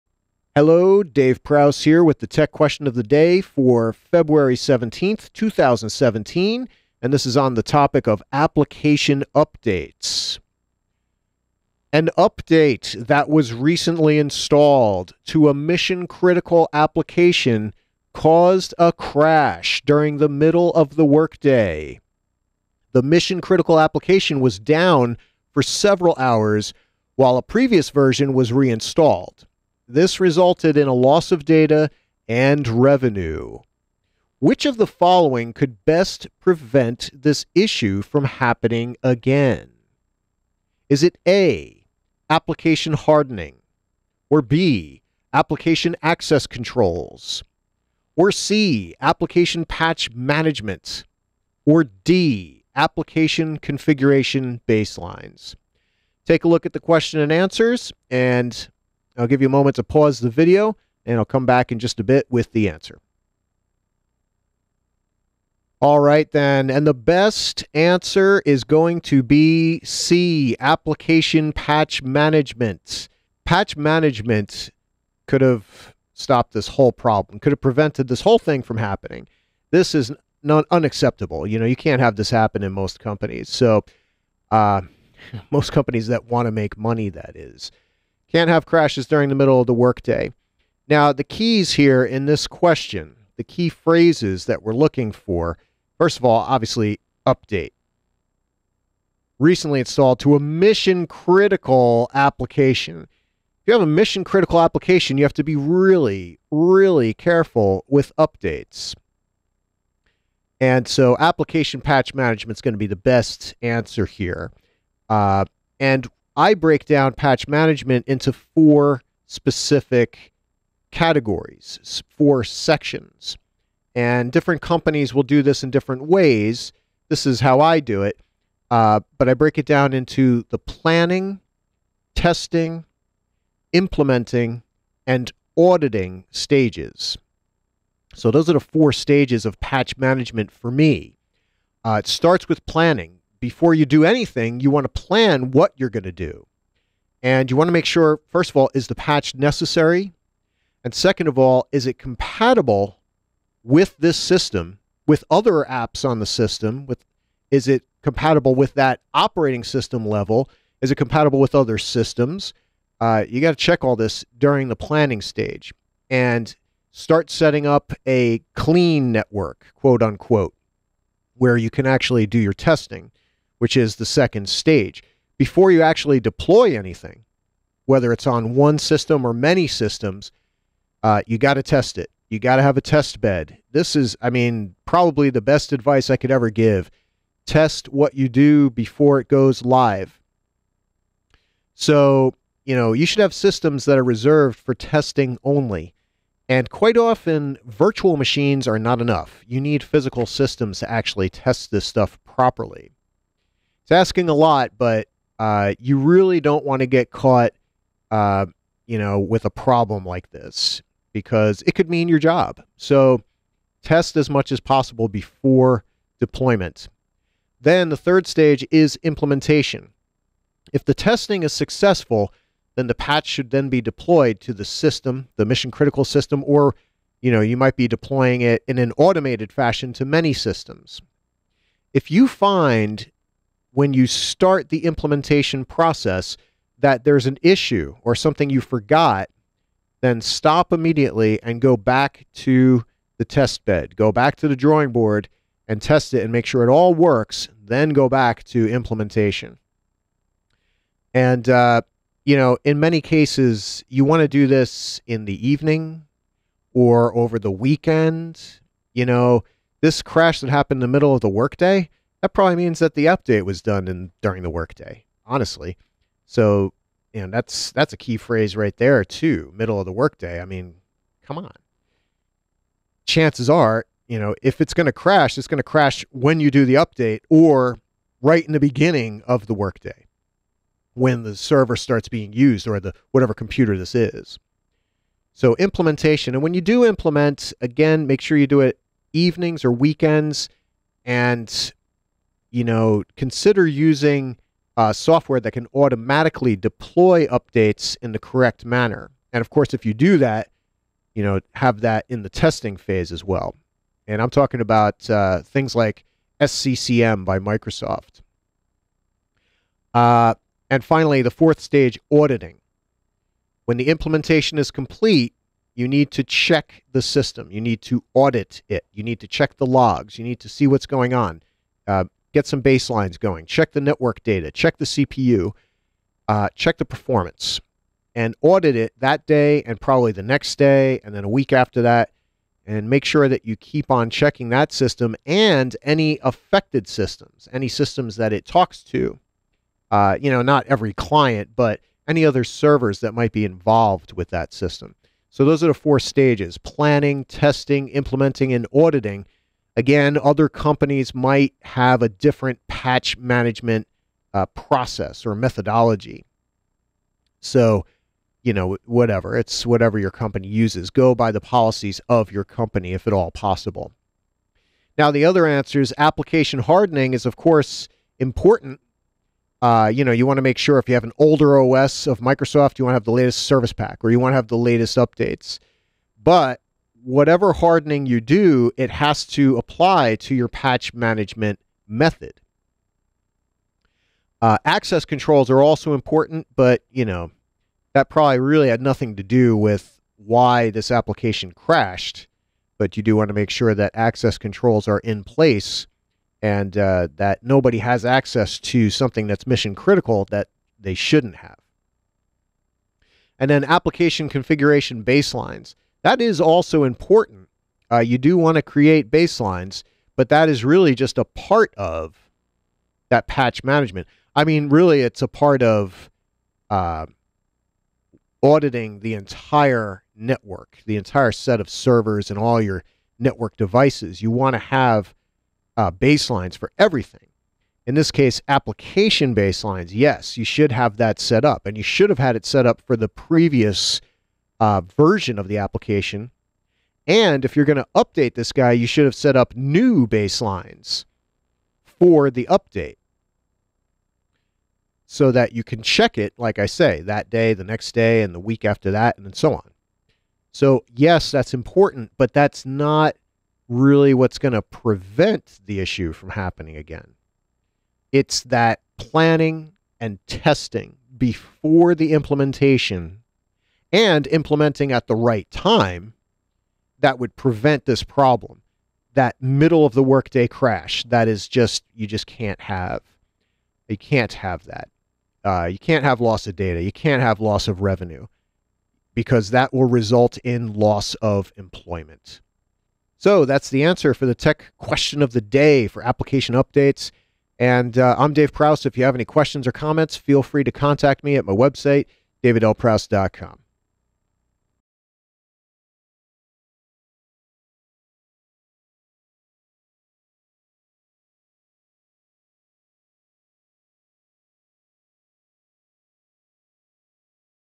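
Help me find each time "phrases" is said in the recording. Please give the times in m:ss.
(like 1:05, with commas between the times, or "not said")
1:33, 4:28.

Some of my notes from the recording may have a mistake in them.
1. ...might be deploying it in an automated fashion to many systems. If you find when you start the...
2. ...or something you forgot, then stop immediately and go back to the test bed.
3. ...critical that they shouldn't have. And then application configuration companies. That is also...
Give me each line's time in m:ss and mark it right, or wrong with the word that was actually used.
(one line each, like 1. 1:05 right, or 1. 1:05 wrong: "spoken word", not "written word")
1. 3:47 right
2. 3:58 right
3. 6:39 wrong: "baselines", not "companies".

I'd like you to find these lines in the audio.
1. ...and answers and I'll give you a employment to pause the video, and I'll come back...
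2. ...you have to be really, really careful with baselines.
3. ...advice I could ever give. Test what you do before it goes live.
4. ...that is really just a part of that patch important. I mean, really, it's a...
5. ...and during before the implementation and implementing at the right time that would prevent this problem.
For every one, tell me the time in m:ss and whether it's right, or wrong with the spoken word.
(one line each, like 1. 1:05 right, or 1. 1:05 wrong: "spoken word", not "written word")
1. 0:57 wrong: "moment", not "employment"
2. 1:45 wrong: "updates", not "baselines"
3. 3:05 right
4. 6:50 wrong: "management", not "important"
5. 7:39 wrong: "testing", not "during".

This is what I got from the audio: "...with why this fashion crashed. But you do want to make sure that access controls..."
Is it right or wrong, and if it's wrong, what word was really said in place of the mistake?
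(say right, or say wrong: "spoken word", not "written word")
wrong: "application", not "fashion".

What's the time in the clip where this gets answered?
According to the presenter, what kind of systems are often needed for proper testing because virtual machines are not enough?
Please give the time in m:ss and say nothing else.
3:19.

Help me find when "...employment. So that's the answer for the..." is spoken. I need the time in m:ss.
8:01.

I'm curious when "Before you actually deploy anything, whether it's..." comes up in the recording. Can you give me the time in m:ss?
2:55.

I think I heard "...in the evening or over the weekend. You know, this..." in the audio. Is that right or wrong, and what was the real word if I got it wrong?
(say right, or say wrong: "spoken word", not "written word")
right.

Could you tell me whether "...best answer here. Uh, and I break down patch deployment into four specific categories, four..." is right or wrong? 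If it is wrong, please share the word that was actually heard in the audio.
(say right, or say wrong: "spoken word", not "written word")
wrong: "management", not "deployment".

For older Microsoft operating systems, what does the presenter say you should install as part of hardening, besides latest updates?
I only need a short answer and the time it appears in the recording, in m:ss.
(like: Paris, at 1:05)
The latest service pack, at 6:13.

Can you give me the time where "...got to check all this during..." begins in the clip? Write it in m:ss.
2:43.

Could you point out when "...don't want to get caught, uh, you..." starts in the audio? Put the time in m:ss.
3:26.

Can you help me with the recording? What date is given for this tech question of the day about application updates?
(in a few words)
February 17th, 2017.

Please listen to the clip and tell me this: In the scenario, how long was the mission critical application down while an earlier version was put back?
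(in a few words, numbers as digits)
Several hours.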